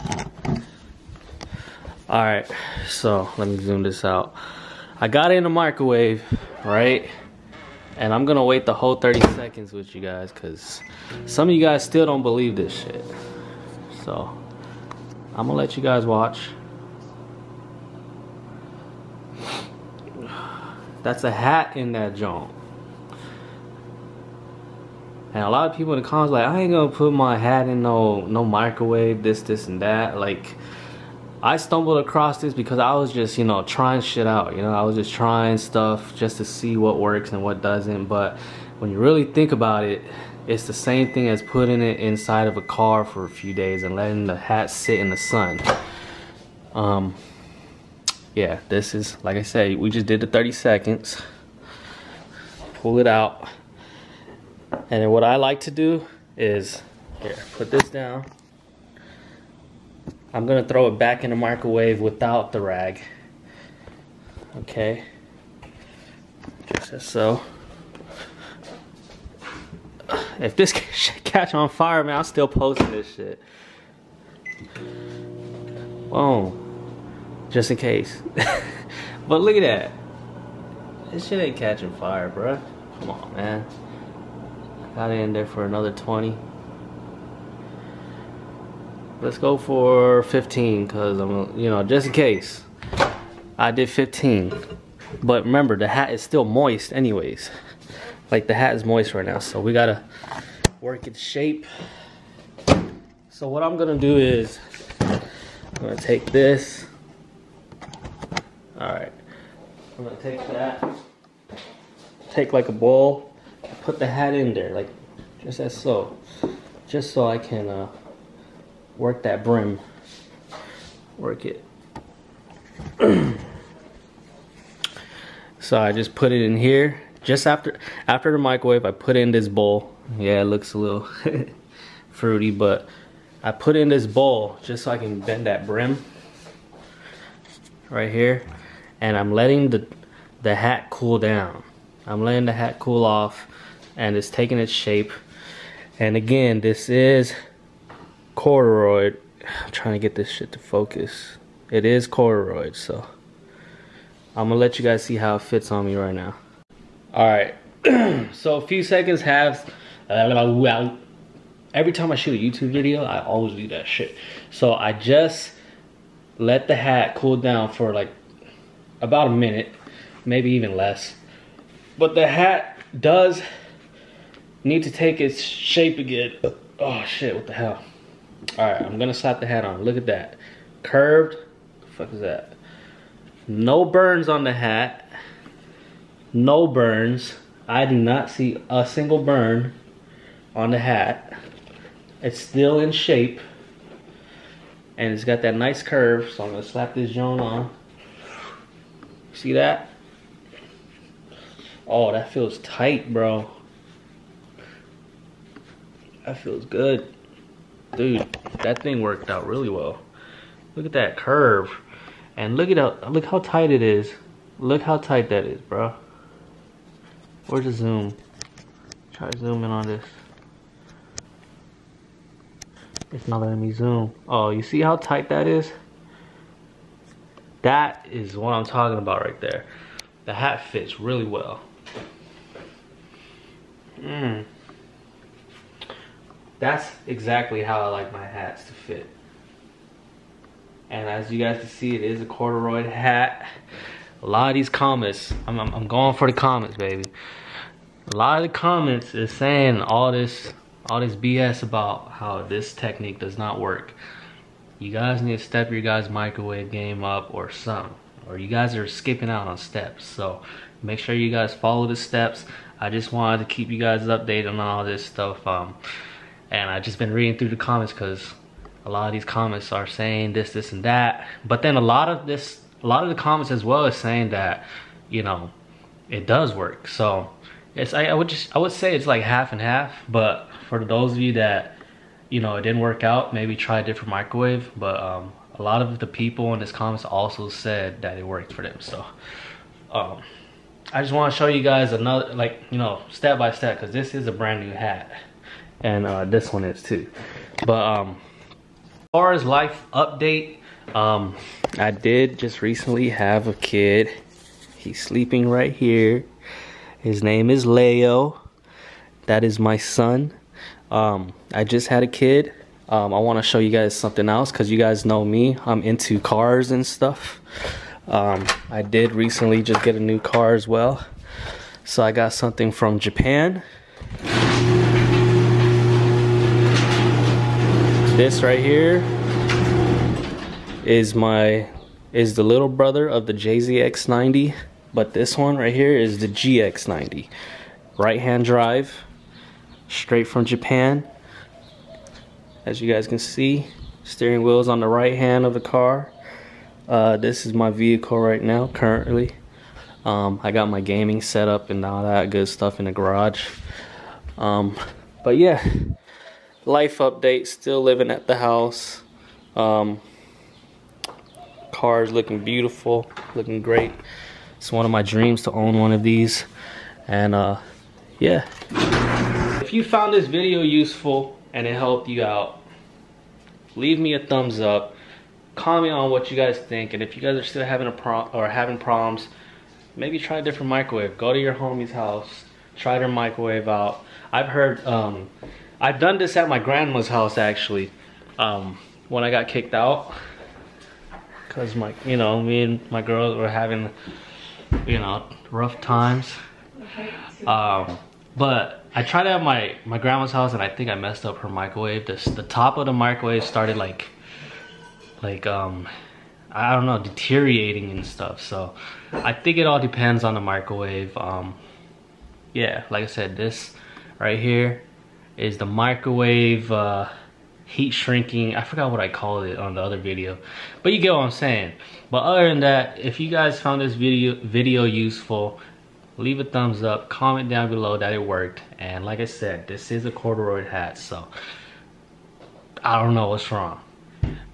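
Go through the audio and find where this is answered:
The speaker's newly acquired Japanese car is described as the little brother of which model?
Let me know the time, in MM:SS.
05:33.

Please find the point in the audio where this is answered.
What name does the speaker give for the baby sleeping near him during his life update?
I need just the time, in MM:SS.
05:06.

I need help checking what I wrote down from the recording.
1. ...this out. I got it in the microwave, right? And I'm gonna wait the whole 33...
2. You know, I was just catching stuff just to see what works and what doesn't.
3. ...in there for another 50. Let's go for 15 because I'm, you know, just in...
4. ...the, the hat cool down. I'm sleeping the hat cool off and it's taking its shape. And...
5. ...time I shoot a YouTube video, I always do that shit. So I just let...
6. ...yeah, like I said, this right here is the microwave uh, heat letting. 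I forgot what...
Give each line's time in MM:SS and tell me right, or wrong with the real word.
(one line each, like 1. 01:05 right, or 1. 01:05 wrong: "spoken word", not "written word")
1. 00:03 wrong: "30", not "33"
2. 00:34 wrong: "trying", not "catching"
3. 01:25 wrong: "20", not "50"
4. 02:19 wrong: "letting", not "sleeping"
5. 02:41 right
6. 06:52 wrong: "shrinking", not "letting".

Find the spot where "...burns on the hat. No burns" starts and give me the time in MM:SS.
03:03.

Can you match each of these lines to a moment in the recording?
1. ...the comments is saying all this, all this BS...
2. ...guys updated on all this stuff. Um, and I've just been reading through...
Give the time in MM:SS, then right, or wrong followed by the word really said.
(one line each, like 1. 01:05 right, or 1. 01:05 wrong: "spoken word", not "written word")
1. 04:08 right
2. 04:23 right.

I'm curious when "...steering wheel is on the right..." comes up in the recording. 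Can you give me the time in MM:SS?
05:44.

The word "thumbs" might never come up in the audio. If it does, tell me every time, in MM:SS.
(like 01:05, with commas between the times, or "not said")
06:14, 07:06.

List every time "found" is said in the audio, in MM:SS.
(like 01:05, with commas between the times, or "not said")
06:09, 07:03.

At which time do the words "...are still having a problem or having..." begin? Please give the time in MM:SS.
06:17.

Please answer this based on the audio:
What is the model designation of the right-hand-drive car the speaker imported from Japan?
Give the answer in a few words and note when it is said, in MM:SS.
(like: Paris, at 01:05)
GX90, at 05:36.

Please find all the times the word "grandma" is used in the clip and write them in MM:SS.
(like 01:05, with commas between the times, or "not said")
06:26, 06:39.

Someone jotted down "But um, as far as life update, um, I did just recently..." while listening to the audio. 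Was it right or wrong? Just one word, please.
right.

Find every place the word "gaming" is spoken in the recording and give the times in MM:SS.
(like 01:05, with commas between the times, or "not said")
05:50.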